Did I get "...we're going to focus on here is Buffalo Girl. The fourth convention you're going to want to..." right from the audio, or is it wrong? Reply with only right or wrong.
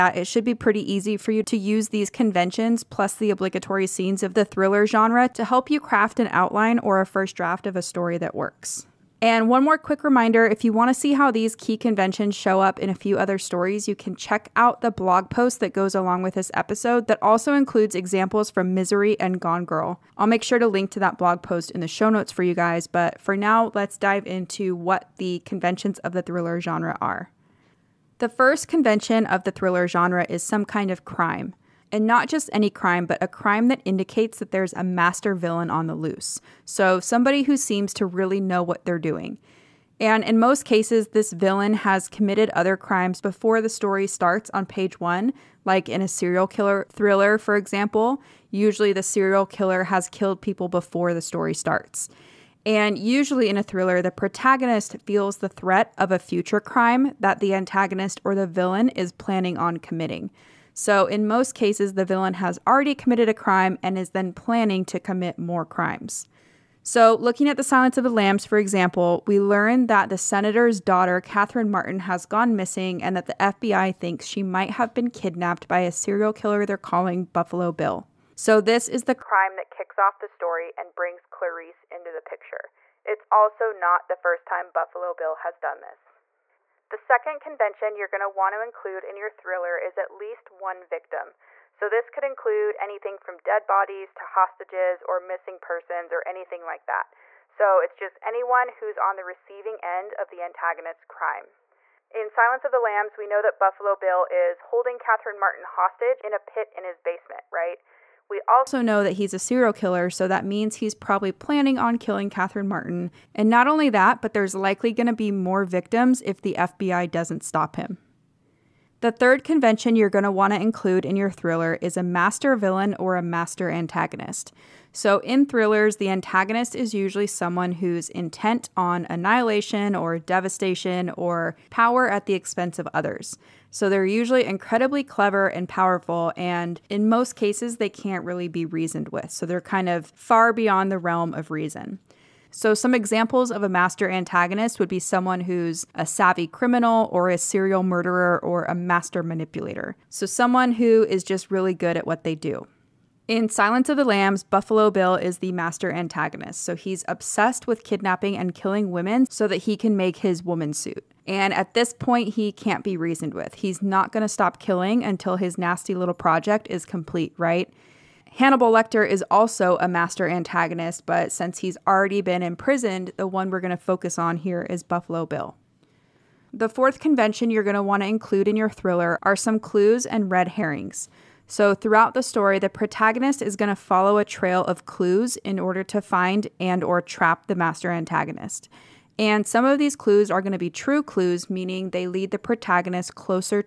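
wrong.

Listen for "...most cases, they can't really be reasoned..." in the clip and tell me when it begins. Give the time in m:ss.
2:17.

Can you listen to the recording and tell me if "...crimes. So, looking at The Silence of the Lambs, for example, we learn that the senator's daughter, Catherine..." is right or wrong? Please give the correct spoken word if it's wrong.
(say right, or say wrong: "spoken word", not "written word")
right.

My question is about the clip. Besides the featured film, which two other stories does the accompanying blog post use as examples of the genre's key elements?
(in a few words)
Misery and Gone Girl.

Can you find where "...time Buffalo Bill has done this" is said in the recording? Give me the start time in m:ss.
1:24.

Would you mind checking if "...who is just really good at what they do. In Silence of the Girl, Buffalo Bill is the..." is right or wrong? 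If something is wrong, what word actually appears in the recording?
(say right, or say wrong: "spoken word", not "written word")
wrong: "Lambs", not "Girl".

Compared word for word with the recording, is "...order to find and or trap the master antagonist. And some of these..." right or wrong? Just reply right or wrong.
right.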